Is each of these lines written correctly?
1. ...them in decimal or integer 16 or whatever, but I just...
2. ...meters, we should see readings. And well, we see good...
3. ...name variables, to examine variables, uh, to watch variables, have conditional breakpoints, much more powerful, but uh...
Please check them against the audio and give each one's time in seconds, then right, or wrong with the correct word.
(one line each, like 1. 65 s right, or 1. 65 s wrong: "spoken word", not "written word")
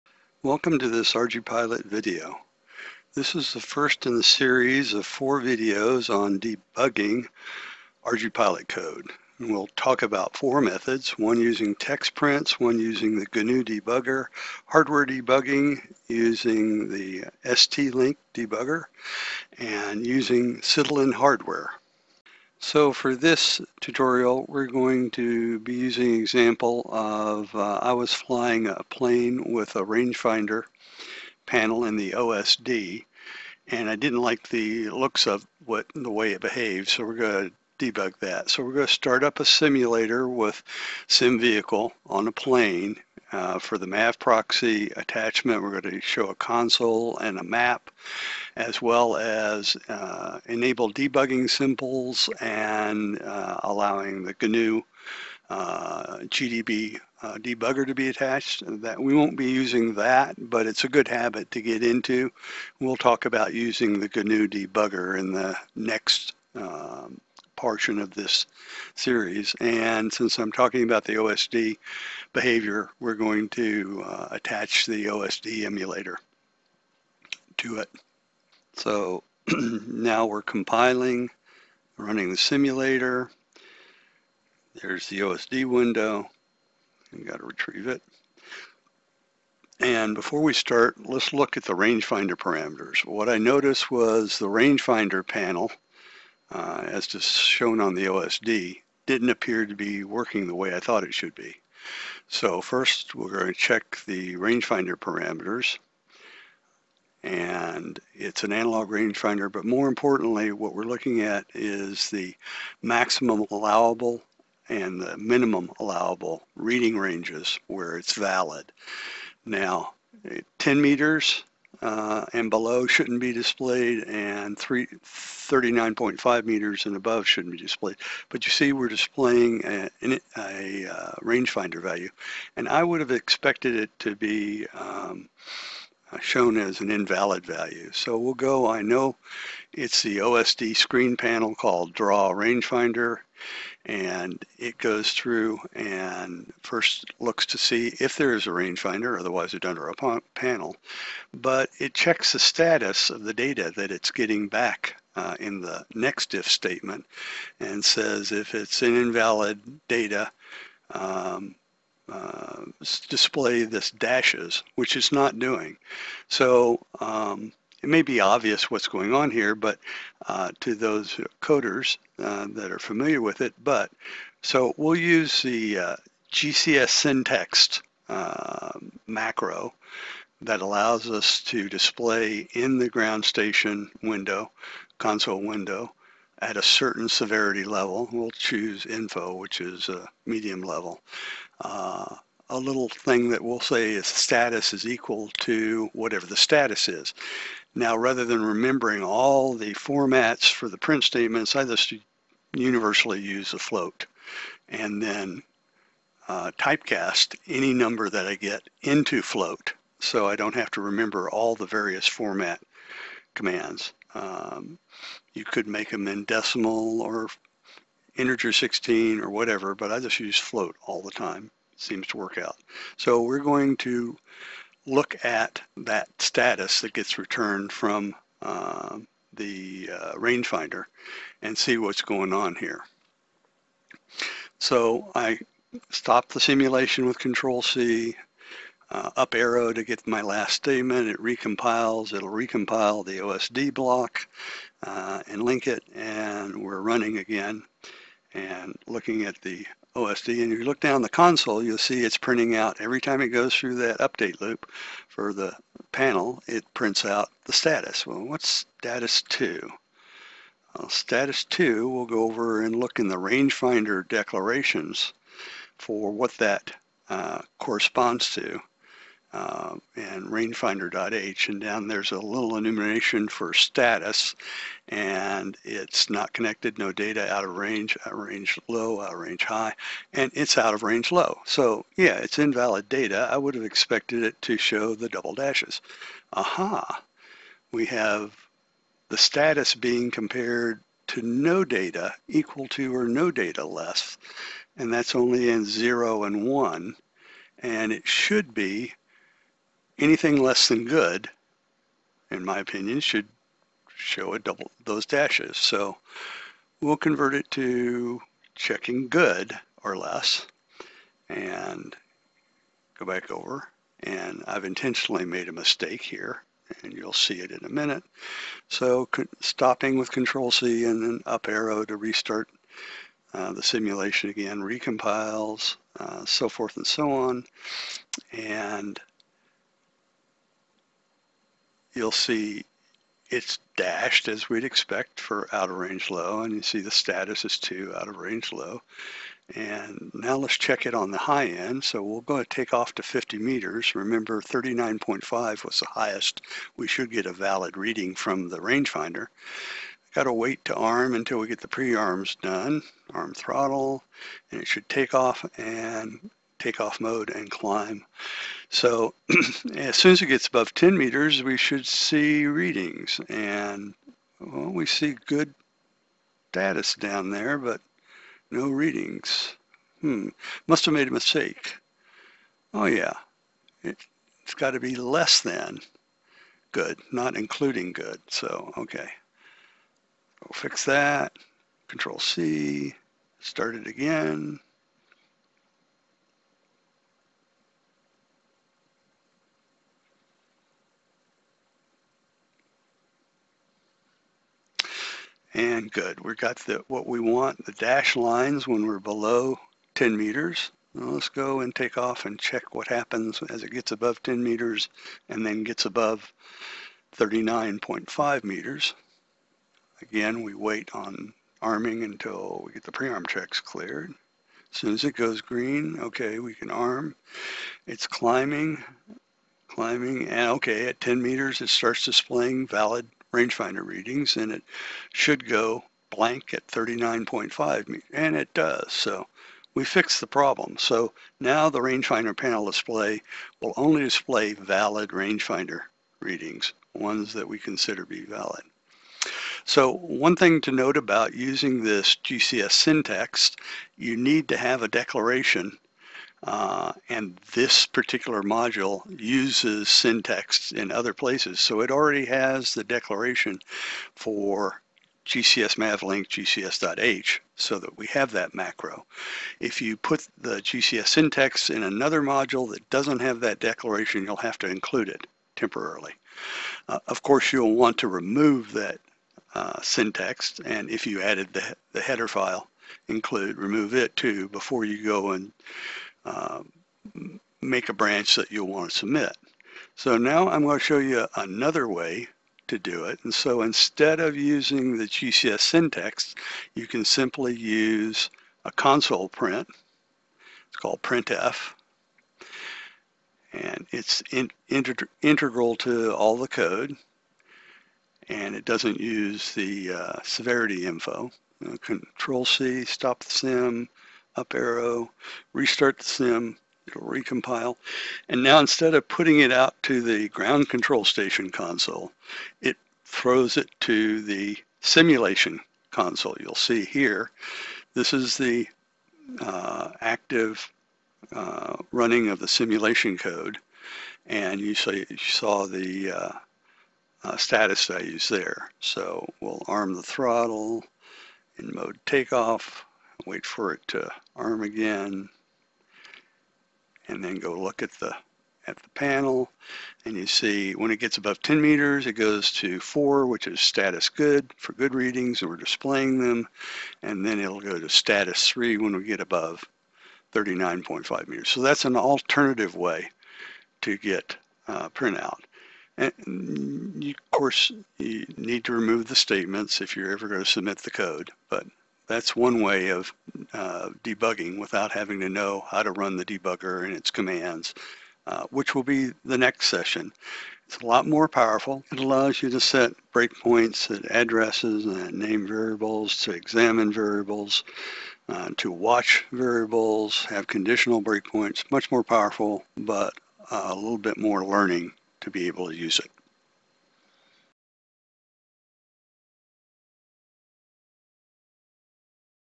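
1. 215 s right
2. 360 s right
3. 575 s right.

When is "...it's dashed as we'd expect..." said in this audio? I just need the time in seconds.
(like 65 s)
333 s.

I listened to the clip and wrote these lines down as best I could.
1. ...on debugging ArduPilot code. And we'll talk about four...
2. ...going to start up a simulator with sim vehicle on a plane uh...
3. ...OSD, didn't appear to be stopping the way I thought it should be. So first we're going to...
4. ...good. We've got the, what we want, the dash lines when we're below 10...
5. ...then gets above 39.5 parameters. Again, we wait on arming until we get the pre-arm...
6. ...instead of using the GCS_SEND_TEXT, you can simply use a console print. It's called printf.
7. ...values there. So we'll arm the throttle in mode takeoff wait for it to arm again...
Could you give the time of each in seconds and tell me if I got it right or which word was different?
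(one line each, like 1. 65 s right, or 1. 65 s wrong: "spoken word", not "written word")
1. 6 s right
2. 38 s right
3. 98 s wrong: "working", not "stopping"
4. 395 s right
5. 405 s wrong: "meters", not "parameters"
6. 483 s right
7. 527 s right.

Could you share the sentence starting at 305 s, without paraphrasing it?
So we'll convert it to checking good or less and go back over.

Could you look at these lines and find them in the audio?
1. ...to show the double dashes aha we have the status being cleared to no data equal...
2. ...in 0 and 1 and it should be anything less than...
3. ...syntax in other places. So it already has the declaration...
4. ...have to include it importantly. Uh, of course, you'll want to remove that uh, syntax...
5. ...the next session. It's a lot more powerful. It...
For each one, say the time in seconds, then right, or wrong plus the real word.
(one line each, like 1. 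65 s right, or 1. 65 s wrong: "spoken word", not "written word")
1. 284 s wrong: "compared", not "cleared"
2. 295 s right
3. 449 s right
4. 464 s wrong: "temporarily", not "importantly"
5. 569 s right.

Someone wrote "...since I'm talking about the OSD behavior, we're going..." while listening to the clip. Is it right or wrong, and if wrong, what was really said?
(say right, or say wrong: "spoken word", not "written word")
right.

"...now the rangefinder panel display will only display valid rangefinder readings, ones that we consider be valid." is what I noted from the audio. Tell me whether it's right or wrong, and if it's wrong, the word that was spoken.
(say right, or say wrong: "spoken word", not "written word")
right.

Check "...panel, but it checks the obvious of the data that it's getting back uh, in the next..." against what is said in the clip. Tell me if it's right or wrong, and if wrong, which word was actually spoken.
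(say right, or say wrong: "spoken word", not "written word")
wrong: "status", not "obvious".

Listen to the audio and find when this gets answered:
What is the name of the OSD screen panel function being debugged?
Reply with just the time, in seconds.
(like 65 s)
141 s.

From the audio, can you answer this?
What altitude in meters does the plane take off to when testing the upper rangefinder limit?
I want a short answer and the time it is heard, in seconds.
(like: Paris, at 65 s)
50 meters, at 343 s.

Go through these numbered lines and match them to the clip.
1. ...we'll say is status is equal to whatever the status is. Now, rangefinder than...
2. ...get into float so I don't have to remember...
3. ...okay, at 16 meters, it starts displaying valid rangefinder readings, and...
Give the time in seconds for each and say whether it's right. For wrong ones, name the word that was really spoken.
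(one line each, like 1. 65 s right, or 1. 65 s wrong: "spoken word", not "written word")
1. 193 s wrong: "rather", not "rangefinder"
2. 208 s right
3. 420 s wrong: "10", not "16".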